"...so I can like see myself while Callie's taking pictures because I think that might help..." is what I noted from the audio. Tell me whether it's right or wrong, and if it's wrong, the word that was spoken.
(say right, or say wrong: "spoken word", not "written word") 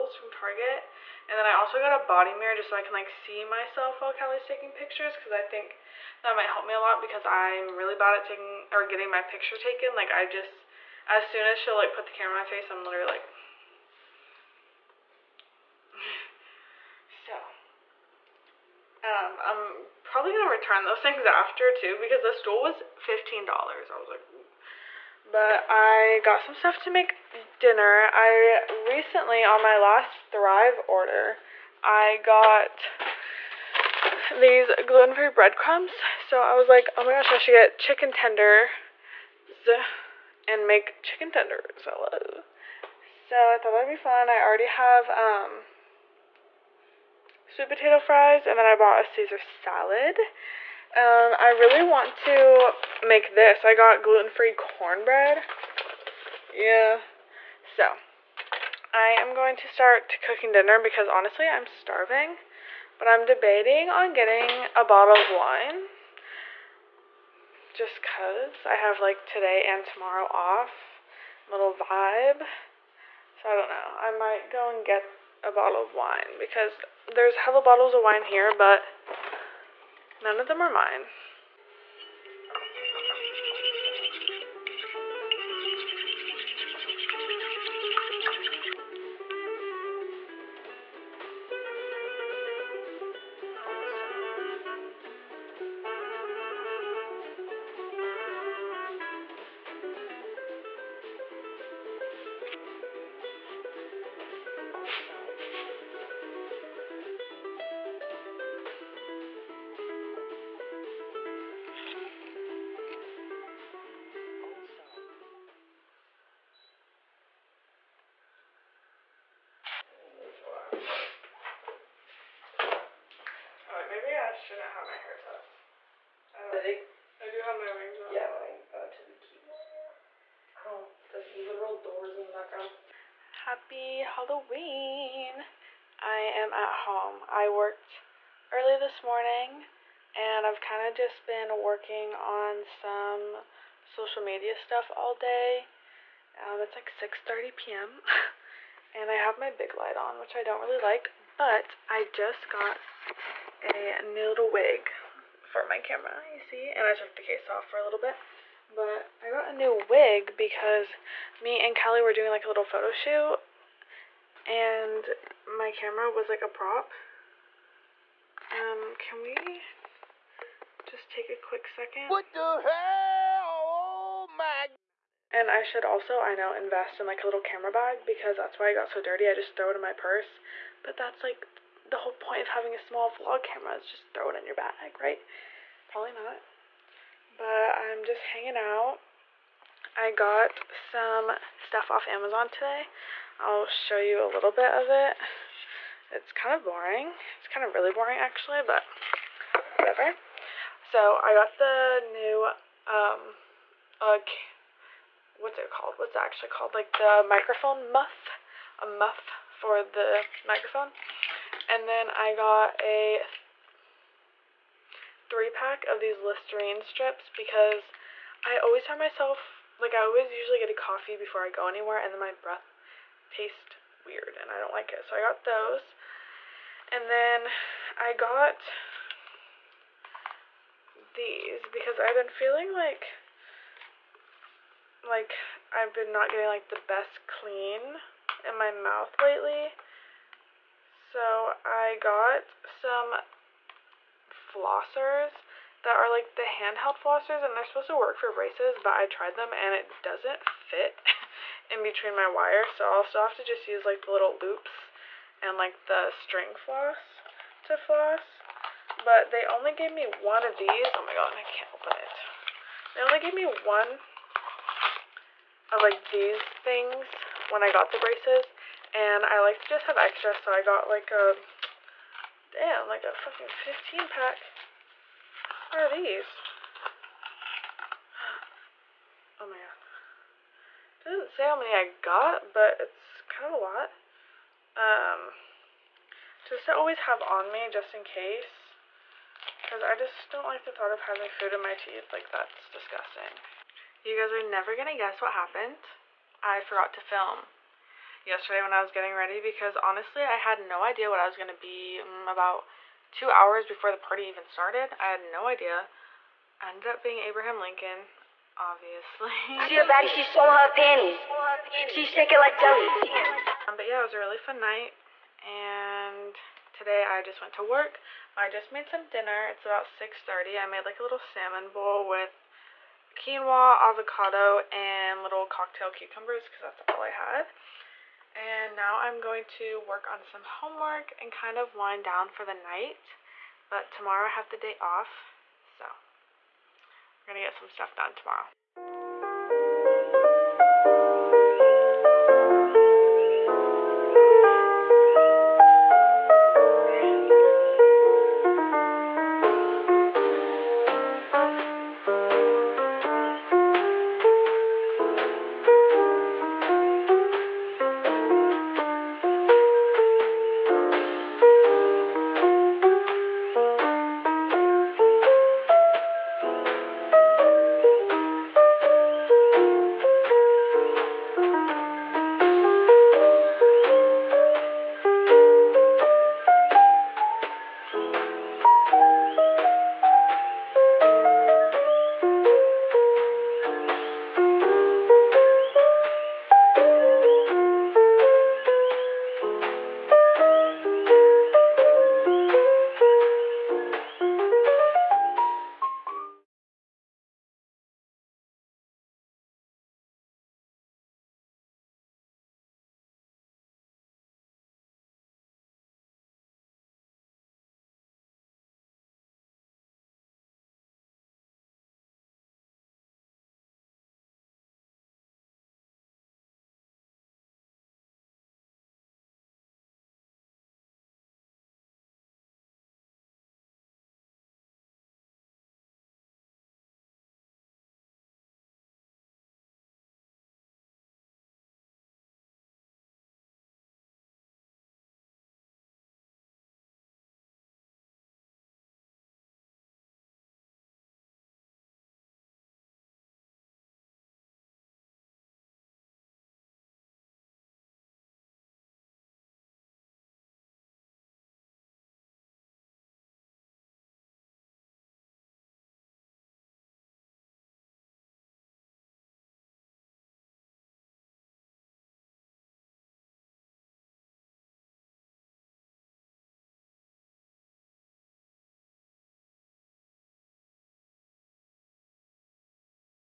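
right.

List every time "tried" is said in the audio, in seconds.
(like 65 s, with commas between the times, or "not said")
249 s.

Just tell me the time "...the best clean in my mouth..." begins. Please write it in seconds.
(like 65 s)
236 s.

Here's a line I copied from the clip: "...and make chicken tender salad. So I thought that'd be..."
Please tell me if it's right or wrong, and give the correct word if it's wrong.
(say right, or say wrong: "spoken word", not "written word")
right.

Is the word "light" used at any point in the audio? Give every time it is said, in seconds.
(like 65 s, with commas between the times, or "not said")
149 s.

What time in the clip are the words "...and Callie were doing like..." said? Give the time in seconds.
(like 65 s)
161 s.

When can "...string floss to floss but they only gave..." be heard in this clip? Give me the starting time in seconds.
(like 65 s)
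256 s.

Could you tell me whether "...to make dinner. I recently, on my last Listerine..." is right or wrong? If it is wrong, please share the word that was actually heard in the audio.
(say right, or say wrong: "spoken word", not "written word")
wrong: "Thrive", not "Listerine".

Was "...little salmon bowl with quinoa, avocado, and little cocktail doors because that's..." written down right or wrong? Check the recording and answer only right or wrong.
wrong.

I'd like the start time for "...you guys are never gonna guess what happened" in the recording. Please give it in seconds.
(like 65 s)
294 s.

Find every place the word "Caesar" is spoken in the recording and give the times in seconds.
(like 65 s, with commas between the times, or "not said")
49 s.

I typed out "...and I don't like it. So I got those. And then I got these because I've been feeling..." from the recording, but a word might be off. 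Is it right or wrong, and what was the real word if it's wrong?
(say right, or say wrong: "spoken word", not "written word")
right.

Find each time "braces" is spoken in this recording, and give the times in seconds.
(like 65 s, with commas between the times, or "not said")
248 s, 267 s.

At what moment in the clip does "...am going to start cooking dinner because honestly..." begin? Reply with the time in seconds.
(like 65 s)
59 s.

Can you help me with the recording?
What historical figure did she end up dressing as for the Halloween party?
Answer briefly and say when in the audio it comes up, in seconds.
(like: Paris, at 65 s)
Abraham Lincoln, at 307 s.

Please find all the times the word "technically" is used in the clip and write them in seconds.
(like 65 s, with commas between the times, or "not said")
not said.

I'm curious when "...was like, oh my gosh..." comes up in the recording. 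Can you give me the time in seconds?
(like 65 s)
36 s.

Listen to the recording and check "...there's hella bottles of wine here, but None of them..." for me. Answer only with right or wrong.
right.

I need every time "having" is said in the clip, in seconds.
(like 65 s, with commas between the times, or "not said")
182 s, 291 s.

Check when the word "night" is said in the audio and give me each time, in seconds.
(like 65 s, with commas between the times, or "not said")
314 s, 332 s.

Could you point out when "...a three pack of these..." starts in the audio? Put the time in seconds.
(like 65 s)
212 s.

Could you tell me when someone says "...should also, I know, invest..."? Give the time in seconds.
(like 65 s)
175 s.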